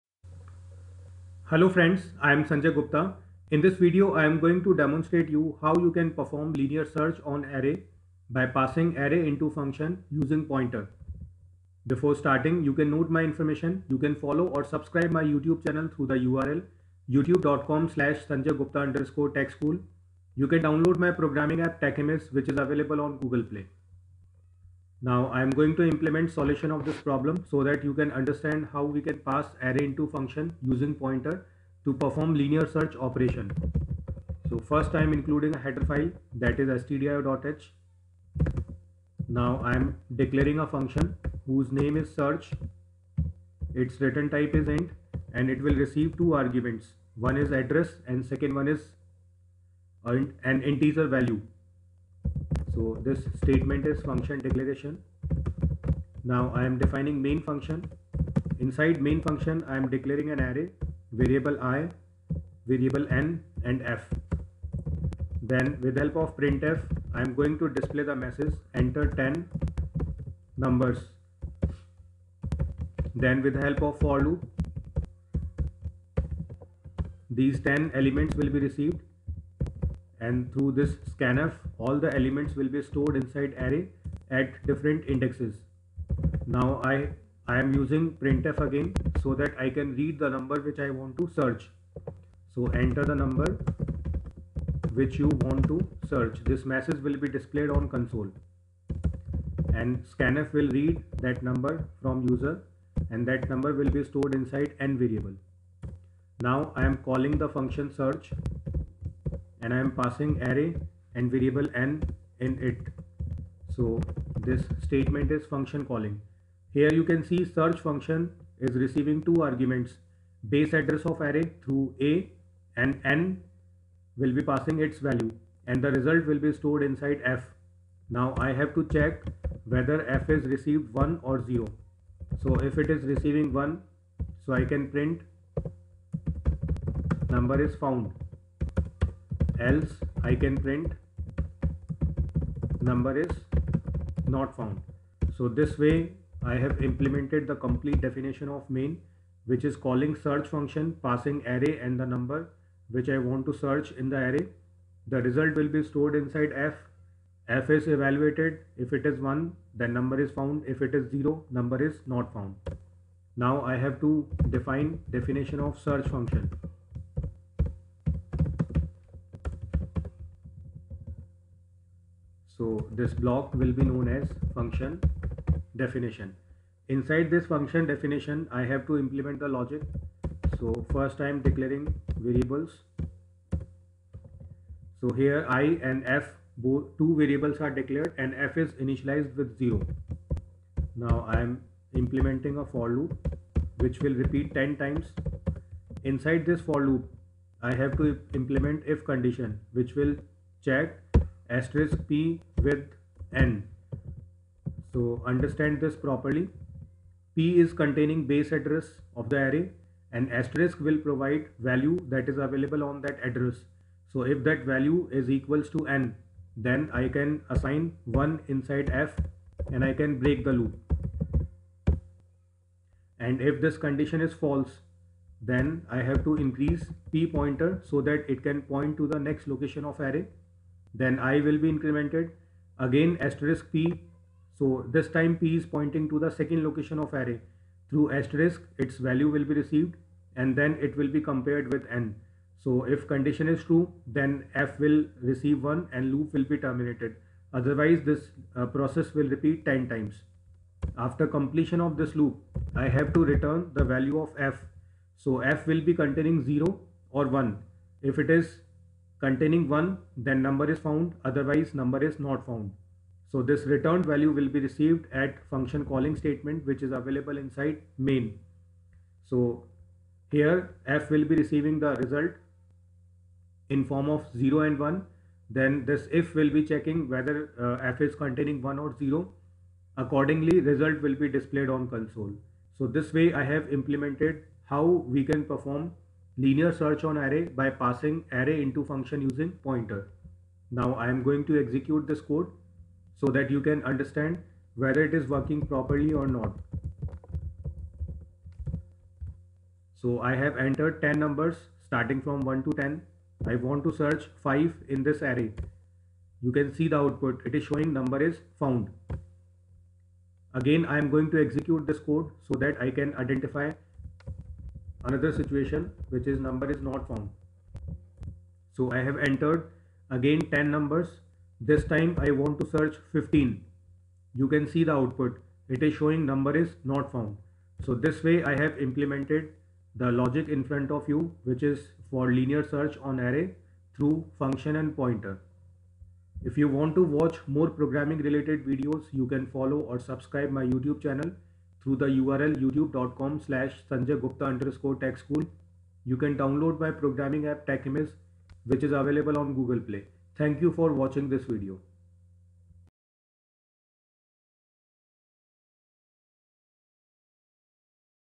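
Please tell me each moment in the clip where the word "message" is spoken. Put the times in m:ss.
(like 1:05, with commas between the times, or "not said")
1:08, 1:36.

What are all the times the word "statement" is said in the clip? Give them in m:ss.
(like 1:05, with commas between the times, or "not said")
0:53, 1:54, 4:26.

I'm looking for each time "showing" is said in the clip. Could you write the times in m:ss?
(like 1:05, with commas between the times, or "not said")
5:07, 5:25.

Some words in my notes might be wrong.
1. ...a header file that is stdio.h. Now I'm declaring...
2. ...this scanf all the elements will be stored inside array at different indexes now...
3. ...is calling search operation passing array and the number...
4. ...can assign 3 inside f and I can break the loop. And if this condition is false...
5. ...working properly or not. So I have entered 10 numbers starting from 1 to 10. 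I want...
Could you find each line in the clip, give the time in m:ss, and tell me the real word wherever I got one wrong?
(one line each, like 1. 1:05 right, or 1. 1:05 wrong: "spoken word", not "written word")
1. 0:35 right
2. 1:20 right
3. 2:29 wrong: "function", not "operation"
4. 3:37 wrong: "1", not "3"
5. 4:55 right.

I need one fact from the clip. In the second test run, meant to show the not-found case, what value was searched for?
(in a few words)
15.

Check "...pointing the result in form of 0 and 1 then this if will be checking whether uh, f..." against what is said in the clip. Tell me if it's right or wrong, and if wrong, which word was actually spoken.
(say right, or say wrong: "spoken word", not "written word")
wrong: "receiving", not "pointing".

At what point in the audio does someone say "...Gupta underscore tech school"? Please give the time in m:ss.
0:18.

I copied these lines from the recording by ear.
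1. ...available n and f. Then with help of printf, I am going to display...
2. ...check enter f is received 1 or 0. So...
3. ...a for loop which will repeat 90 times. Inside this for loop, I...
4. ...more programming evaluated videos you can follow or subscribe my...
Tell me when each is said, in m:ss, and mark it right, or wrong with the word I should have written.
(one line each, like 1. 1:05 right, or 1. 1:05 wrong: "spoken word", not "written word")
1. 1:02 wrong: "variable", not "available"
2. 2:08 wrong: "whether", not "enter"
3. 3:12 wrong: "10", not "90"
4. 5:37 wrong: "related", not "evaluated".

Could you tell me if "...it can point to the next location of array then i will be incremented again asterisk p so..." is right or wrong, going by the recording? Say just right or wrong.
right.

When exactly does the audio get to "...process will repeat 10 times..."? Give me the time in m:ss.
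4:08.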